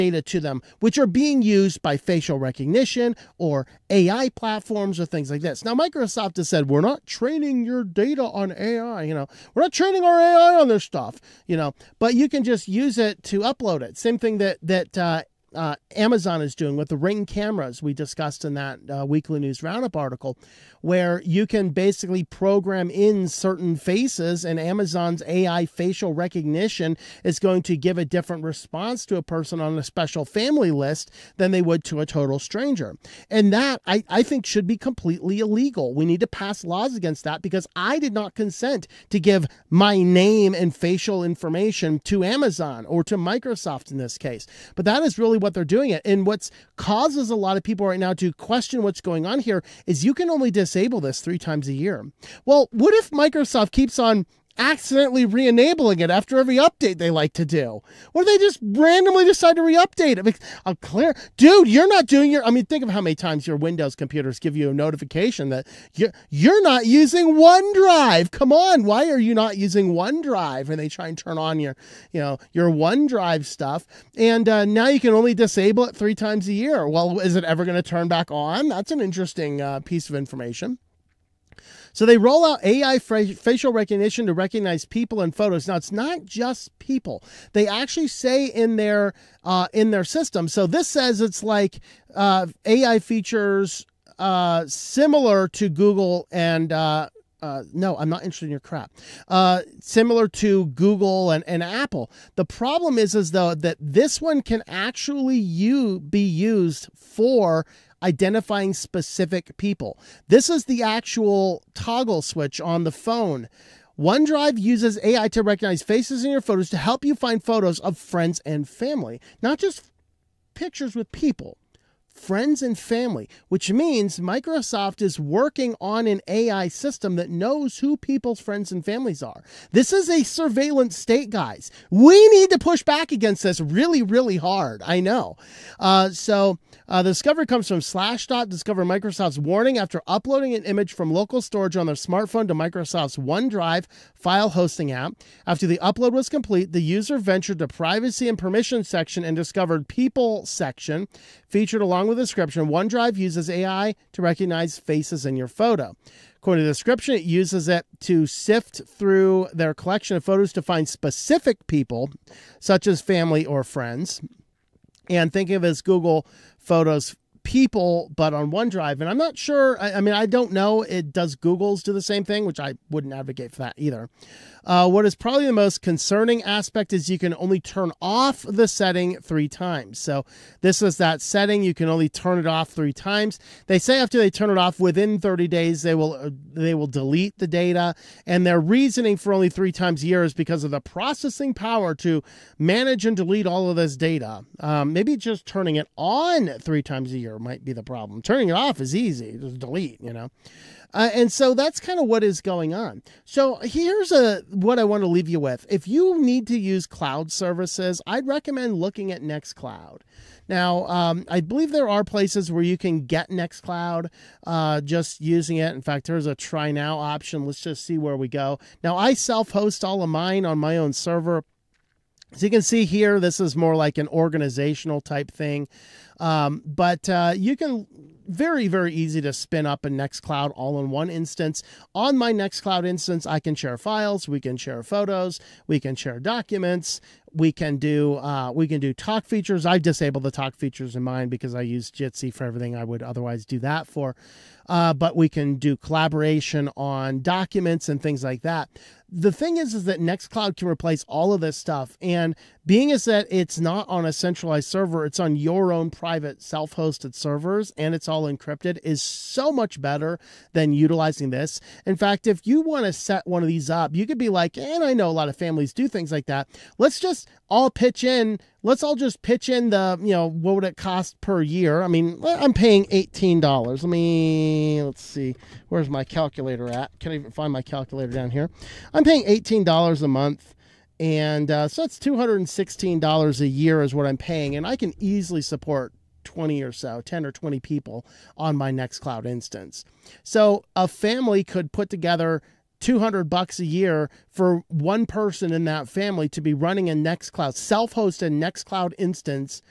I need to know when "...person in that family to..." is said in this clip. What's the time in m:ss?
4:55.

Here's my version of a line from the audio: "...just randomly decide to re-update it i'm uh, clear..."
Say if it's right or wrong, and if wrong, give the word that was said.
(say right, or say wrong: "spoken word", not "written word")
right.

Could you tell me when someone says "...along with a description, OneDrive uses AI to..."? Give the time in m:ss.
2:32.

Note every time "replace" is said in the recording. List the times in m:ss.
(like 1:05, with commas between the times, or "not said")
4:10.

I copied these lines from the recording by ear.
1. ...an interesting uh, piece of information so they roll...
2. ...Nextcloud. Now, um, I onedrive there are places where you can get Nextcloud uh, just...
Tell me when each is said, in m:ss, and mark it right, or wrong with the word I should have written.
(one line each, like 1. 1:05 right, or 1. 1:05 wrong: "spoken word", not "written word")
1. 1:18 right
2. 3:29 wrong: "believe", not "onedrive".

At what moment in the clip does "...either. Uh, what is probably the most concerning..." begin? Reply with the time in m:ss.
2:53.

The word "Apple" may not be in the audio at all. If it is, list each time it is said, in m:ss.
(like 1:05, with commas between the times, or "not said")
1:41.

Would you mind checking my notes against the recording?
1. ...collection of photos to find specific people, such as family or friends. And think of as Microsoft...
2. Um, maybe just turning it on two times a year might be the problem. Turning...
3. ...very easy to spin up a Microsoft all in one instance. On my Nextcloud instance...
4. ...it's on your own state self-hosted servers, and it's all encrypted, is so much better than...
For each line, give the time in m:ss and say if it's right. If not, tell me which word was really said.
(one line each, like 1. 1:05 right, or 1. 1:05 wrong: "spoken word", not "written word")
1. 2:39 wrong: "Google", not "Microsoft"
2. 3:14 wrong: "three", not "two"
3. 3:48 wrong: "Nextcloud", not "Microsoft"
4. 4:15 wrong: "private", not "state".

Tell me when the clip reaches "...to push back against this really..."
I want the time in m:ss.
2:12.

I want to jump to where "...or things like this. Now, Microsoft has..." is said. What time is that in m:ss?
0:04.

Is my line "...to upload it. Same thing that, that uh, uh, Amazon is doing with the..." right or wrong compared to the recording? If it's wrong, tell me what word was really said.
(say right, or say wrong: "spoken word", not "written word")
right.